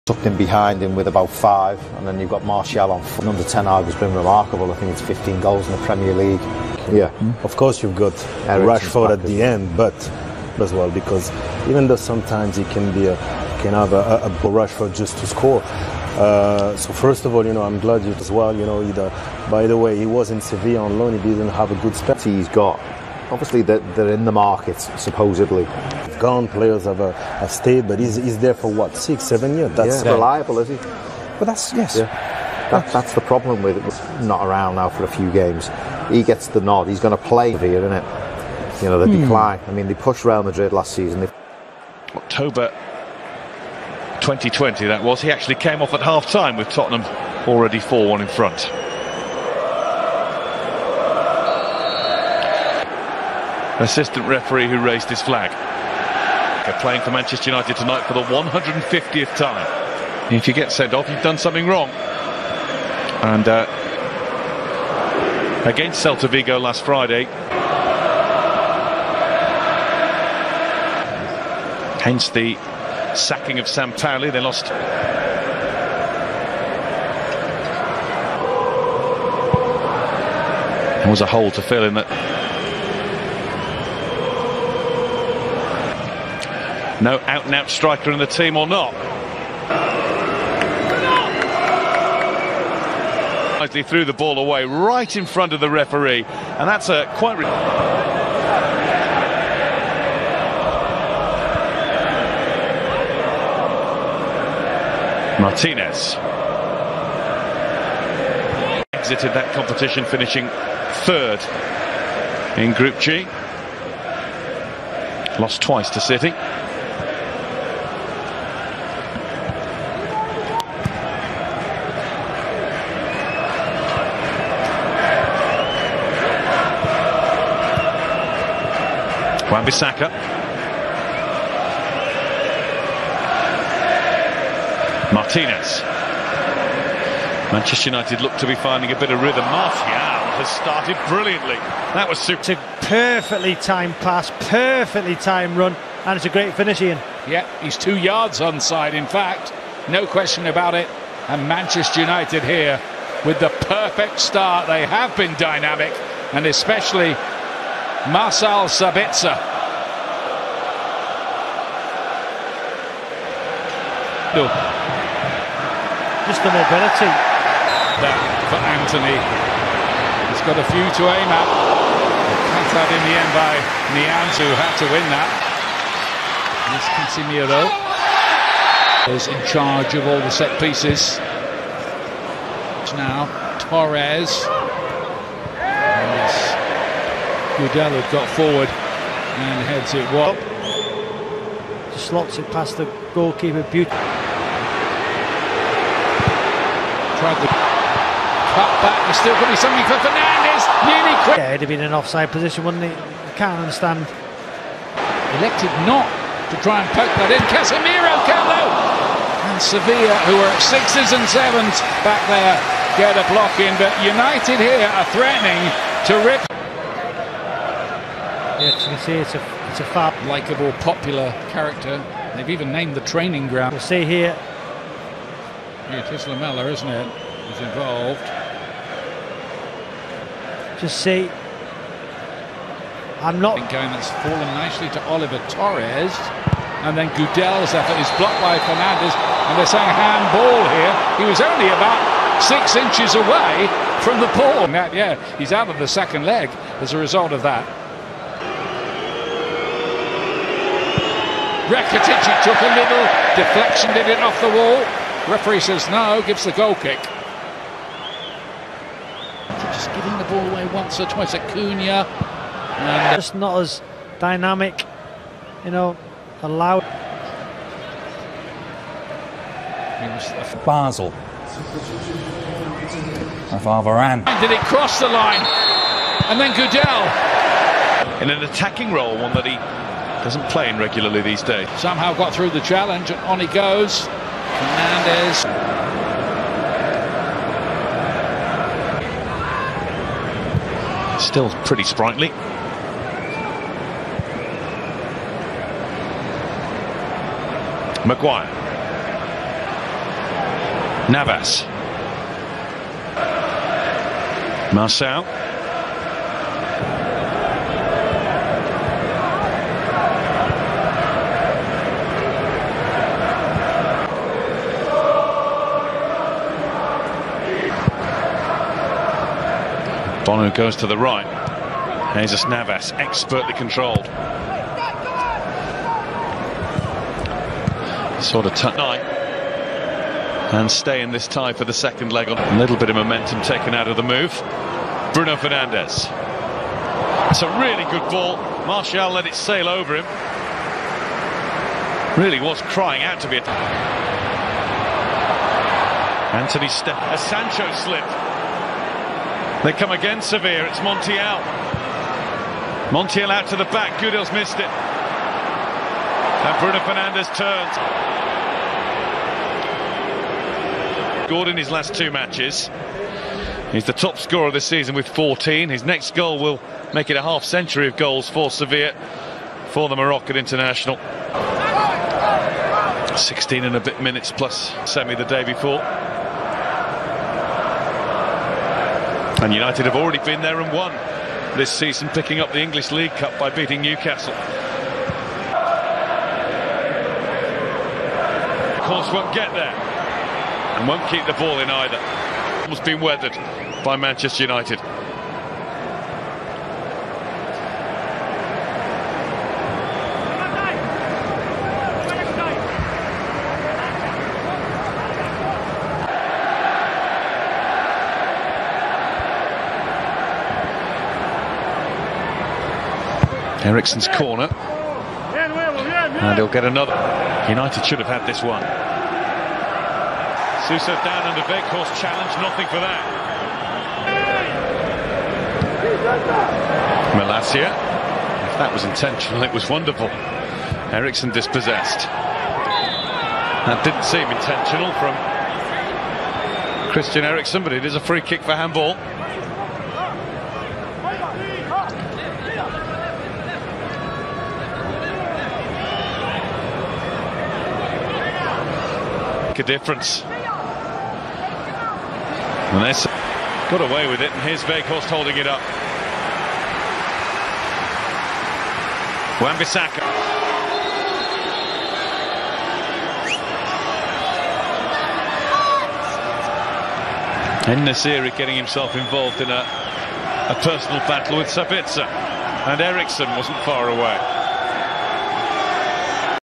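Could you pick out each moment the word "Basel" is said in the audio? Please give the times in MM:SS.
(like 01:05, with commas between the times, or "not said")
04:30.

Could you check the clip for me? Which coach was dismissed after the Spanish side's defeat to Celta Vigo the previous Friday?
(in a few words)
Sam Sampaoli.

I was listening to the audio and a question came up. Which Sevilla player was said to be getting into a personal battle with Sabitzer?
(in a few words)
Nasiri.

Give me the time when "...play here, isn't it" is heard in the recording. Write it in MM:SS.
00:37.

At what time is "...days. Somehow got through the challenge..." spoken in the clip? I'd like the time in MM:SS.
04:41.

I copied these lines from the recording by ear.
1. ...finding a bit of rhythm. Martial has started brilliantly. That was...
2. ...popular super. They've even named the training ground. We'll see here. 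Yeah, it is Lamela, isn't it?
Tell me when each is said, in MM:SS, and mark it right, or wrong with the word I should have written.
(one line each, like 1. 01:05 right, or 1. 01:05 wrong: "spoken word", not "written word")
1. 02:18 right
2. 03:40 wrong: "character", not "super".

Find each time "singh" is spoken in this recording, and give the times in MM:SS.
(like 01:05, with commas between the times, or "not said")
not said.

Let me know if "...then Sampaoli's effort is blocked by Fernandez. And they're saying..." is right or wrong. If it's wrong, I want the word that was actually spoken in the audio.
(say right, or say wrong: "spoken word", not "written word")
wrong: "Gudelj", not "Sampaoli".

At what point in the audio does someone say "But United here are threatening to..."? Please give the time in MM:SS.
03:33.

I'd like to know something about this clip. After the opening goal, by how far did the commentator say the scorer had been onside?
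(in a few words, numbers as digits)
2 yards.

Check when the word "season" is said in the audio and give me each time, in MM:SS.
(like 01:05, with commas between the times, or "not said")
00:40, 06:04, 06:21.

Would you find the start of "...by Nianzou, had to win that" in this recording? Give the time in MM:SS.
02:53.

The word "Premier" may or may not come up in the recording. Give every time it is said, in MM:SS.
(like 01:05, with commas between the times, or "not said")
00:05.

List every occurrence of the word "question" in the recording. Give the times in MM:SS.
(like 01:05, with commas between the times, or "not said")
02:30.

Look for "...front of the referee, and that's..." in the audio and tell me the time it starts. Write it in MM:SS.
01:35.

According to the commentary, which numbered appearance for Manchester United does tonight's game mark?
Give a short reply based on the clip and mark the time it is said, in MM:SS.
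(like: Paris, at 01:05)
150th, at 00:58.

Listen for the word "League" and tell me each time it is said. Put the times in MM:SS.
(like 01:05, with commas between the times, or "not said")
00:06, 06:22.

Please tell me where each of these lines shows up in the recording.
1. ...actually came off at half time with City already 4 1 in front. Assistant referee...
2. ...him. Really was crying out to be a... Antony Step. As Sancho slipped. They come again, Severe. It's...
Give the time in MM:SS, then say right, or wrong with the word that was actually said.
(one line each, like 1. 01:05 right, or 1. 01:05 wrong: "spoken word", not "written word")
1. 00:45 wrong: "Tottenham", not "City"
2. 05:39 right.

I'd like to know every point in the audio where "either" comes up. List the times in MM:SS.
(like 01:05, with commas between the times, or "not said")
00:18, 06:31.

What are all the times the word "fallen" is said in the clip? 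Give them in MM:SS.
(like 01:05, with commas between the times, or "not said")
03:54.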